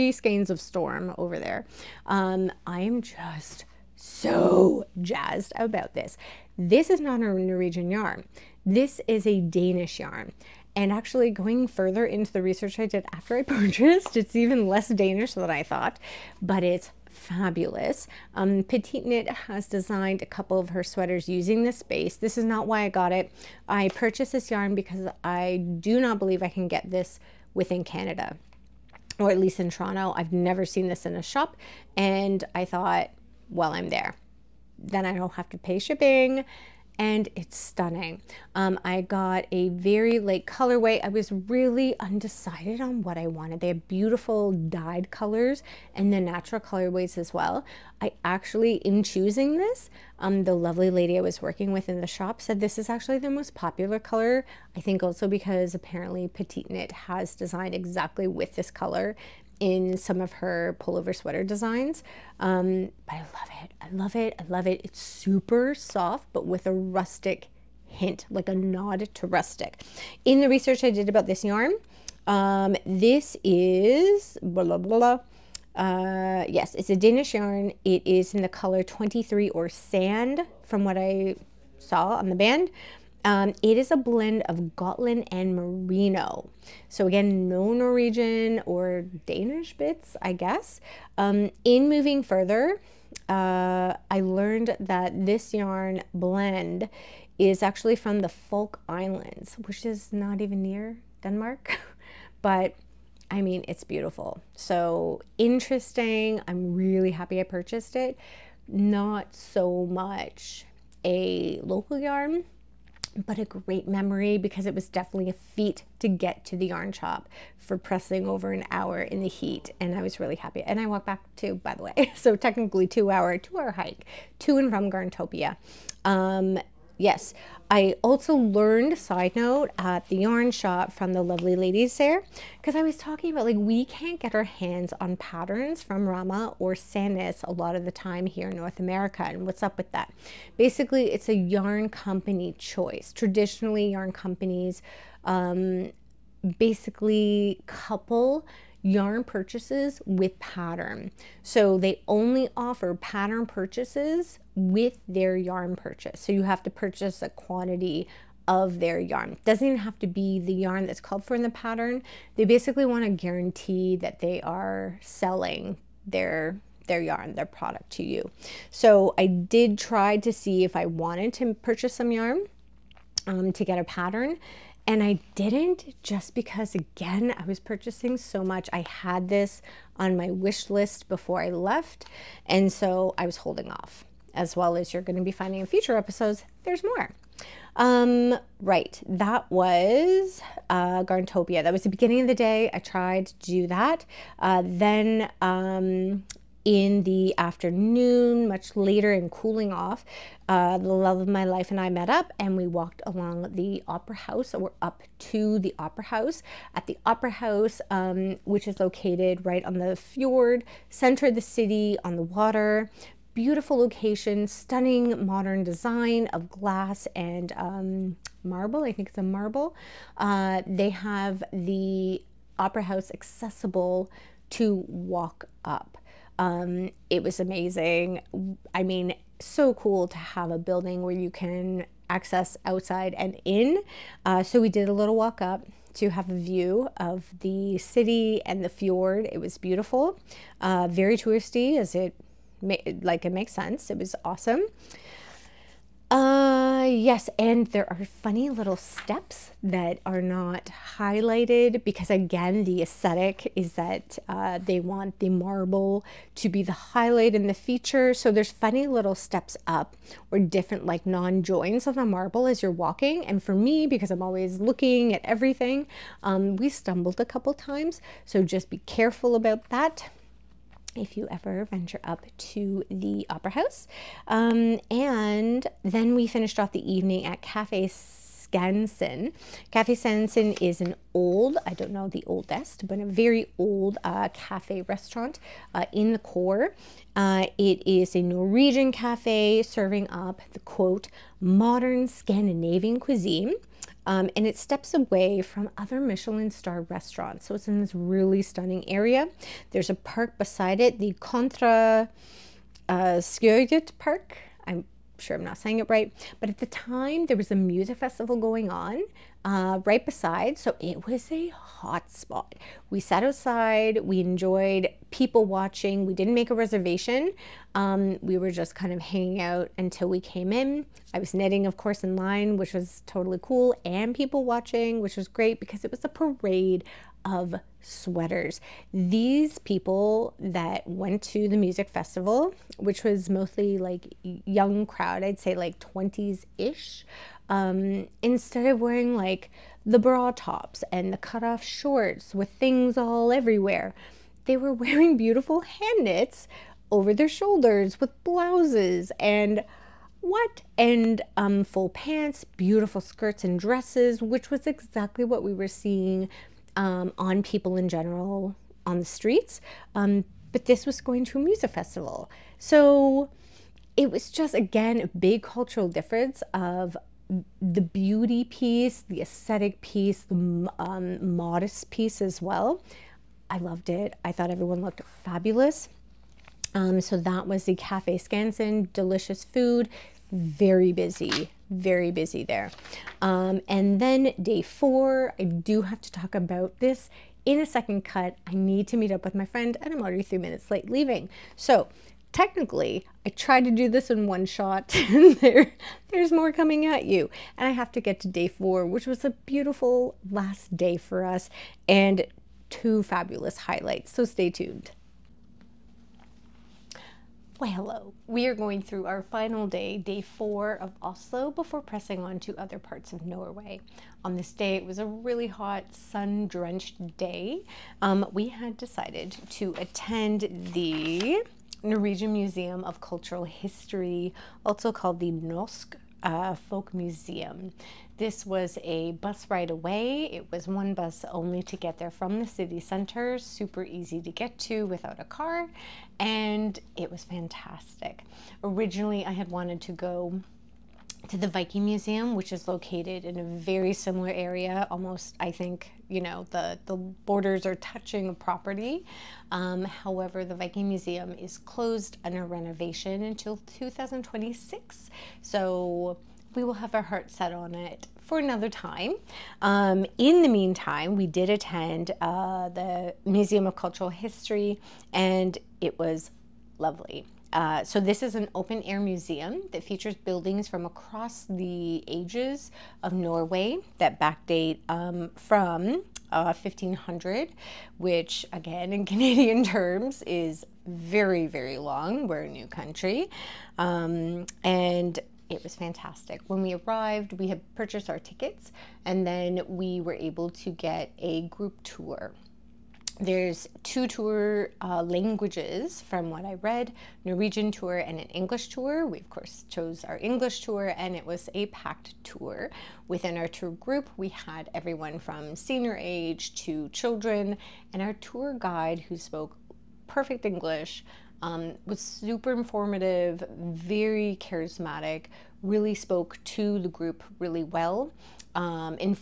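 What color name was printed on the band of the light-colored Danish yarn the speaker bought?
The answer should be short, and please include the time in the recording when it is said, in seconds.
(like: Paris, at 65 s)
Sand, at 79 s.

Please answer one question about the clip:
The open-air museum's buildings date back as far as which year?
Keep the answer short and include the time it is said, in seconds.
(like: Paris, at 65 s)
1500, at 476 s.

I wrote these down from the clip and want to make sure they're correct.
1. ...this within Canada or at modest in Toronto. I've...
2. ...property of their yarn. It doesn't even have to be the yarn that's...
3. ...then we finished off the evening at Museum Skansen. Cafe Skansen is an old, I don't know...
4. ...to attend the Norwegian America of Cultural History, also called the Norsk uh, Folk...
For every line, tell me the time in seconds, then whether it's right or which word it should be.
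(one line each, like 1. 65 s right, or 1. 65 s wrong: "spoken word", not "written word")
1. 26 s wrong: "least", not "modest"
2. 157 s wrong: "quantity", not "property"
3. 275 s wrong: "Cafe", not "Museum"
4. 419 s wrong: "Museum", not "America".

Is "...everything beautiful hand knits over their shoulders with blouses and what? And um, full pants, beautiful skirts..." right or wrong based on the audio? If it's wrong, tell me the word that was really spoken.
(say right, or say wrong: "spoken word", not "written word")
wrong: "wearing", not "everything".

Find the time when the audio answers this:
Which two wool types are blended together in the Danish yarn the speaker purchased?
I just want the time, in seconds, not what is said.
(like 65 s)
84 s.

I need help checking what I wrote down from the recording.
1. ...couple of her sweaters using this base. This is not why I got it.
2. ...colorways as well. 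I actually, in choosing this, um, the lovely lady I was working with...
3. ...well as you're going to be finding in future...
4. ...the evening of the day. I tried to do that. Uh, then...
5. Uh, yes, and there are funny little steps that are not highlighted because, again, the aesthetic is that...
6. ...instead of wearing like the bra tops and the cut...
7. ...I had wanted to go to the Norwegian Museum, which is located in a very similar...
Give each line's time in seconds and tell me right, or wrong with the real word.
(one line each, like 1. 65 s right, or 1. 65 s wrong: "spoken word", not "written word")
1. 20 s right
2. 46 s right
3. 184 s right
4. 191 s wrong: "beginning", not "evening"
5. 246 s right
6. 338 s right
7. 439 s wrong: "Viking", not "Norwegian".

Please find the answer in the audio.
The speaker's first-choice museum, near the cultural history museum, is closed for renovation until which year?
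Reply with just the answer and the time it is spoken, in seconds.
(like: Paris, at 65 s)
2026, at 453 s.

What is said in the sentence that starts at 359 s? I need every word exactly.
Um, but this was going to a music festival.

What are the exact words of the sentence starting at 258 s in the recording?
So there's funny little steps up or different, like non joins of the marble as you're walking.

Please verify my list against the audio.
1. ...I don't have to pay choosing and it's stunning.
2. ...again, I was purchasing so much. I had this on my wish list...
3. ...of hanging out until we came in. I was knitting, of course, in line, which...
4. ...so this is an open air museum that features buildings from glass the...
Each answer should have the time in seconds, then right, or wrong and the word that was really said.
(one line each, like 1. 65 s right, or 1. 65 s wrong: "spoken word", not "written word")
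1. 35 s wrong: "shipping", not "choosing"
2. 176 s right
3. 318 s right
4. 467 s wrong: "across", not "glass".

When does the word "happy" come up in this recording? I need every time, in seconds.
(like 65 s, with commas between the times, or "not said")
107 s, 120 s.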